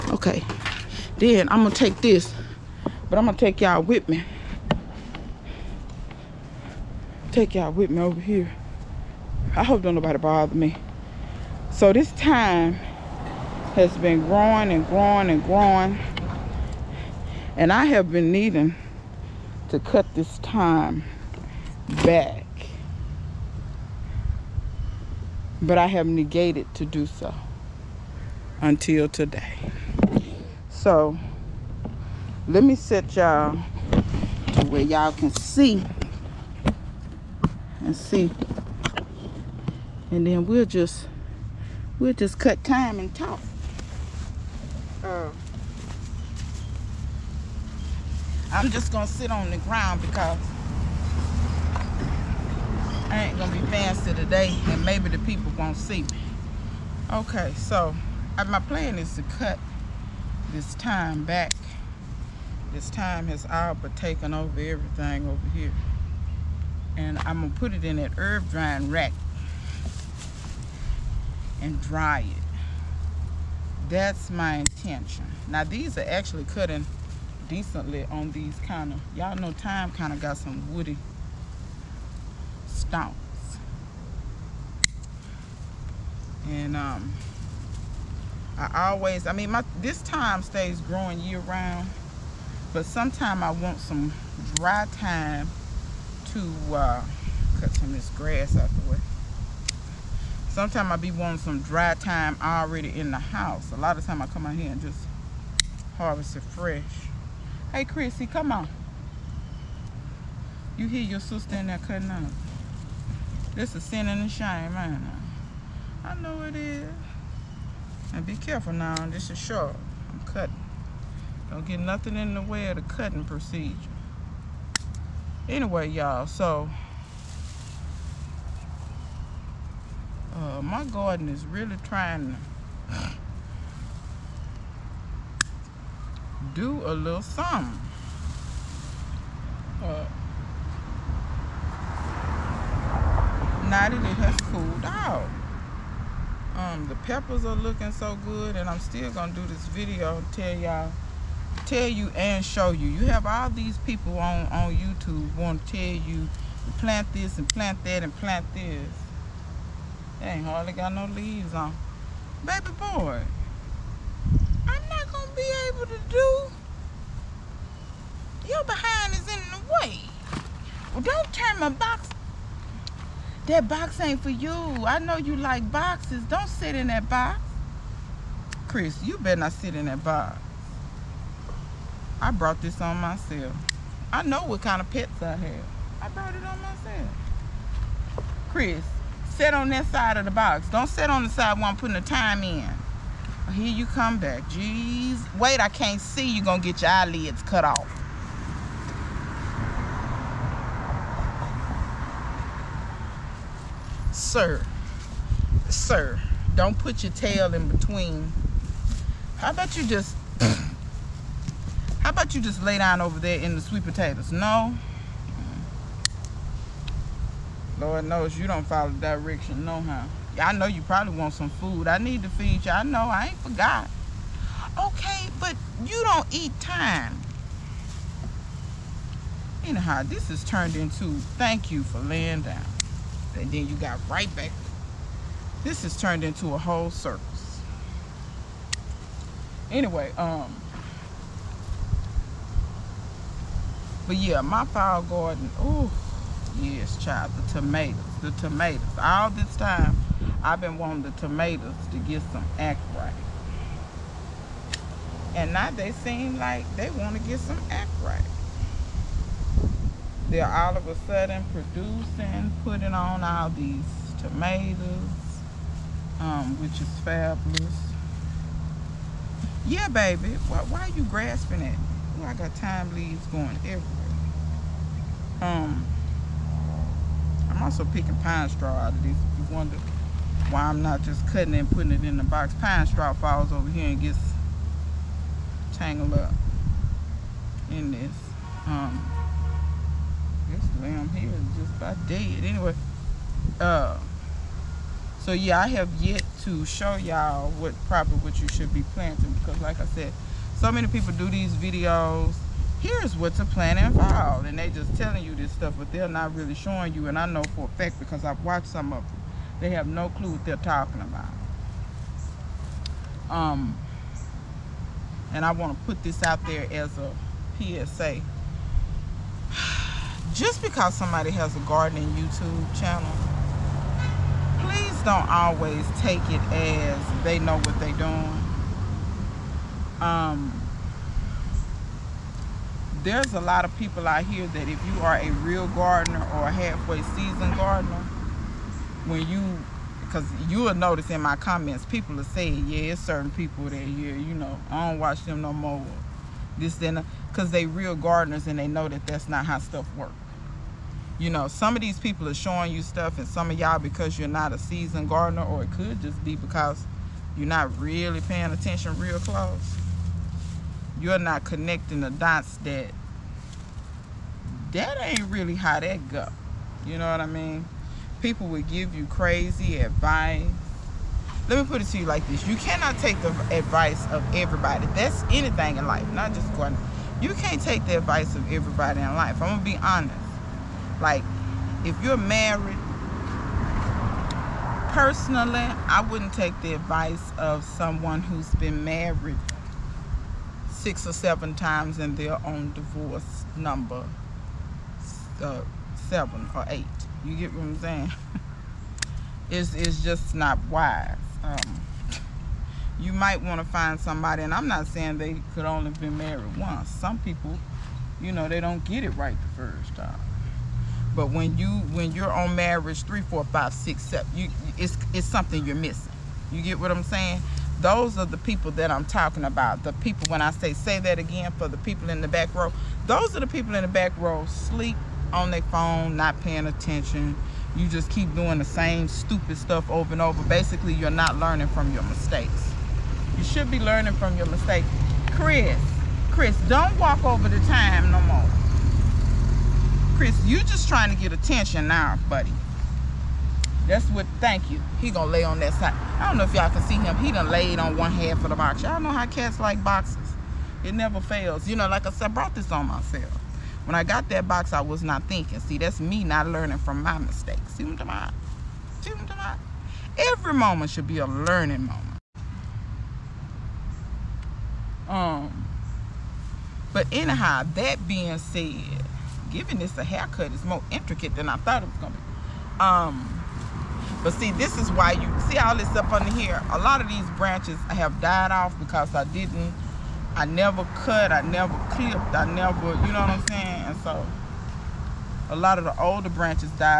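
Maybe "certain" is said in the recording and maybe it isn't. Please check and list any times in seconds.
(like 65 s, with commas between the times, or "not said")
343 s.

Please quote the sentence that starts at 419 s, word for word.
The people when I say say that again for the people in the back row.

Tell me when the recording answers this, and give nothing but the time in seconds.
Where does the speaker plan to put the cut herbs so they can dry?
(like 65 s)
68 s.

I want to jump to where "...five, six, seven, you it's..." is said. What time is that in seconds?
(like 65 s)
413 s.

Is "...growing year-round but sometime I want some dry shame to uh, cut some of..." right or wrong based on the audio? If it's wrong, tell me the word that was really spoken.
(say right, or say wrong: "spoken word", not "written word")
wrong: "thyme", not "shame".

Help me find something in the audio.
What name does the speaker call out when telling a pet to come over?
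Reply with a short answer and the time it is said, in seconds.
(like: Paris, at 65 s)
Chrissy, at 107 s.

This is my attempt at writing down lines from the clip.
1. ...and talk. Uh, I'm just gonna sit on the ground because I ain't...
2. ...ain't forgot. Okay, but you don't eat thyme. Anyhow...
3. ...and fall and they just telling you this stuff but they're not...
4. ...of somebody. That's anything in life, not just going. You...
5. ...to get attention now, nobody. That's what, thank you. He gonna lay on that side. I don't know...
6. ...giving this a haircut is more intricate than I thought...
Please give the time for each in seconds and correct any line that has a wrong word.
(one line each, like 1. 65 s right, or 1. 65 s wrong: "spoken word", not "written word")
1. 42 s right
2. 223 s right
3. 303 s right
4. 374 s wrong: "everybody", not "somebody"
5. 441 s wrong: "buddy", not "nobody"
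6. 469 s right.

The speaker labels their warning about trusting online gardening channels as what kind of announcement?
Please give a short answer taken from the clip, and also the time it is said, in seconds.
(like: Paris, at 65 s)
PSA, at 317 s.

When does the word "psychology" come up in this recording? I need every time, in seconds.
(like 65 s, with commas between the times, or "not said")
not said.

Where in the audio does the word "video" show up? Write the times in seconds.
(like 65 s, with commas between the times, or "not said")
149 s, 301 s.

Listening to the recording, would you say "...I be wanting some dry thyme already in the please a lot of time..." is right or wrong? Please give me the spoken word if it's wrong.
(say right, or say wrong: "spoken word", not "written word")
wrong: "house", not "please".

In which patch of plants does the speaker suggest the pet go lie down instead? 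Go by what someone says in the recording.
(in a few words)
Sweet potatoes.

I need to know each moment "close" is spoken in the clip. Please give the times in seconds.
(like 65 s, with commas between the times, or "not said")
359 s.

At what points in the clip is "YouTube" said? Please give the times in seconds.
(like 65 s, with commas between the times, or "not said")
154 s, 322 s.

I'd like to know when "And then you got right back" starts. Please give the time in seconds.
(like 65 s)
233 s.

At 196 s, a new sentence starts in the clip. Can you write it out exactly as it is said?
You're going to get your eyelids cut off.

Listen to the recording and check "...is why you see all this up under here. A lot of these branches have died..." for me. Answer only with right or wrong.
right.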